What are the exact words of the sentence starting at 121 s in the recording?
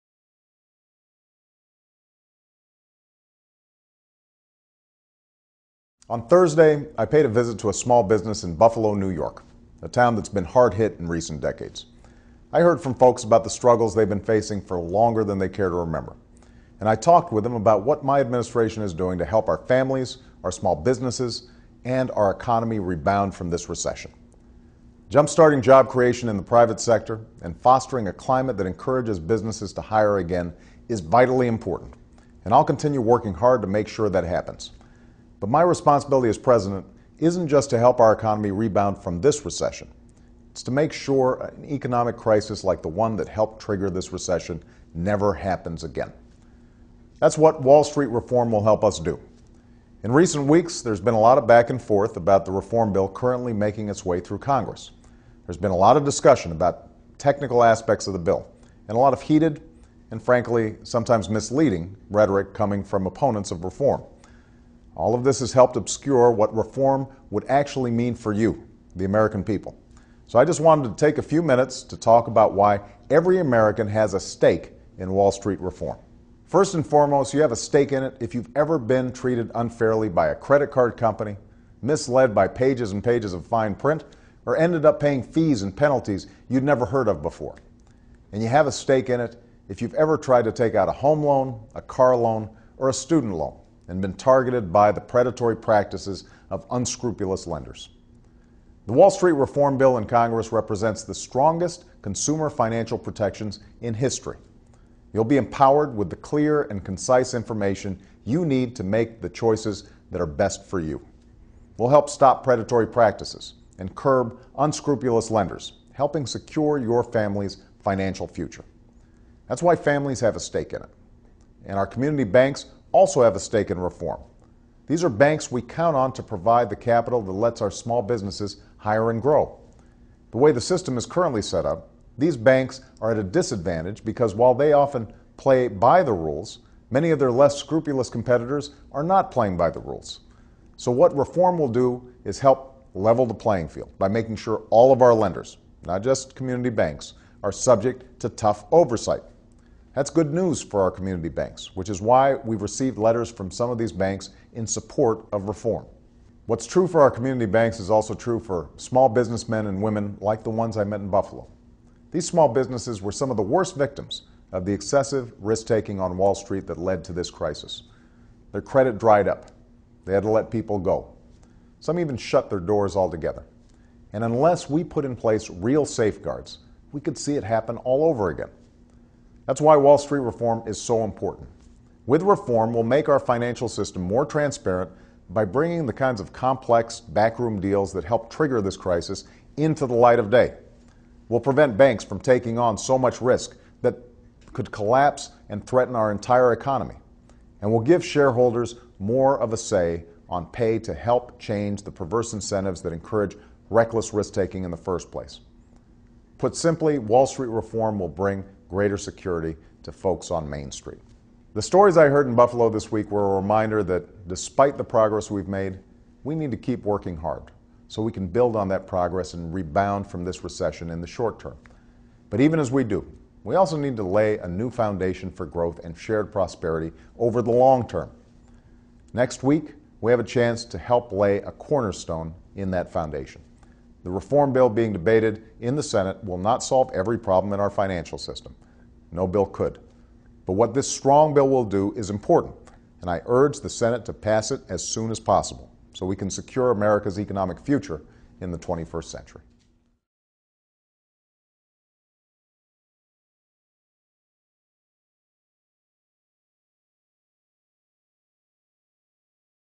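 And our community banks also have a stake in reform.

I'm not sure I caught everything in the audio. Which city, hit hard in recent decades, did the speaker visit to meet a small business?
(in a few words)
Buffalo, New York.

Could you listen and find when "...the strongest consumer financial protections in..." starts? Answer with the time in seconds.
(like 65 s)
101 s.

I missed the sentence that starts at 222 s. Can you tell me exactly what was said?
But even as we do, we also need to lay a new foundation for growth and shared prosperity over the long term.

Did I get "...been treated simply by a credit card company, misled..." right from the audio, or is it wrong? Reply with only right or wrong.
wrong.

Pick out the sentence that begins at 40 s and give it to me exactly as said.
It's to make sure an economic crisis like the one that helped trigger this recession never happens again.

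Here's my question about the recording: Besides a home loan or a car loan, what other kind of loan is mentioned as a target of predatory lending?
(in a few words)
student loan.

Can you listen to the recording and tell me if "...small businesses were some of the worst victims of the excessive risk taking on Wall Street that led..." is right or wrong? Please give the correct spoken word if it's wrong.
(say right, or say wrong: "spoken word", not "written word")
right.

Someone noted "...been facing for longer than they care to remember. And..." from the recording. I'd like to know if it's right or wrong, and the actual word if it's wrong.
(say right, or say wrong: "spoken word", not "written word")
right.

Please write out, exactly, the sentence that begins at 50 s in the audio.
In recent weeks, there's been a lot of back and forth about the reform bill currently making its way through Congress.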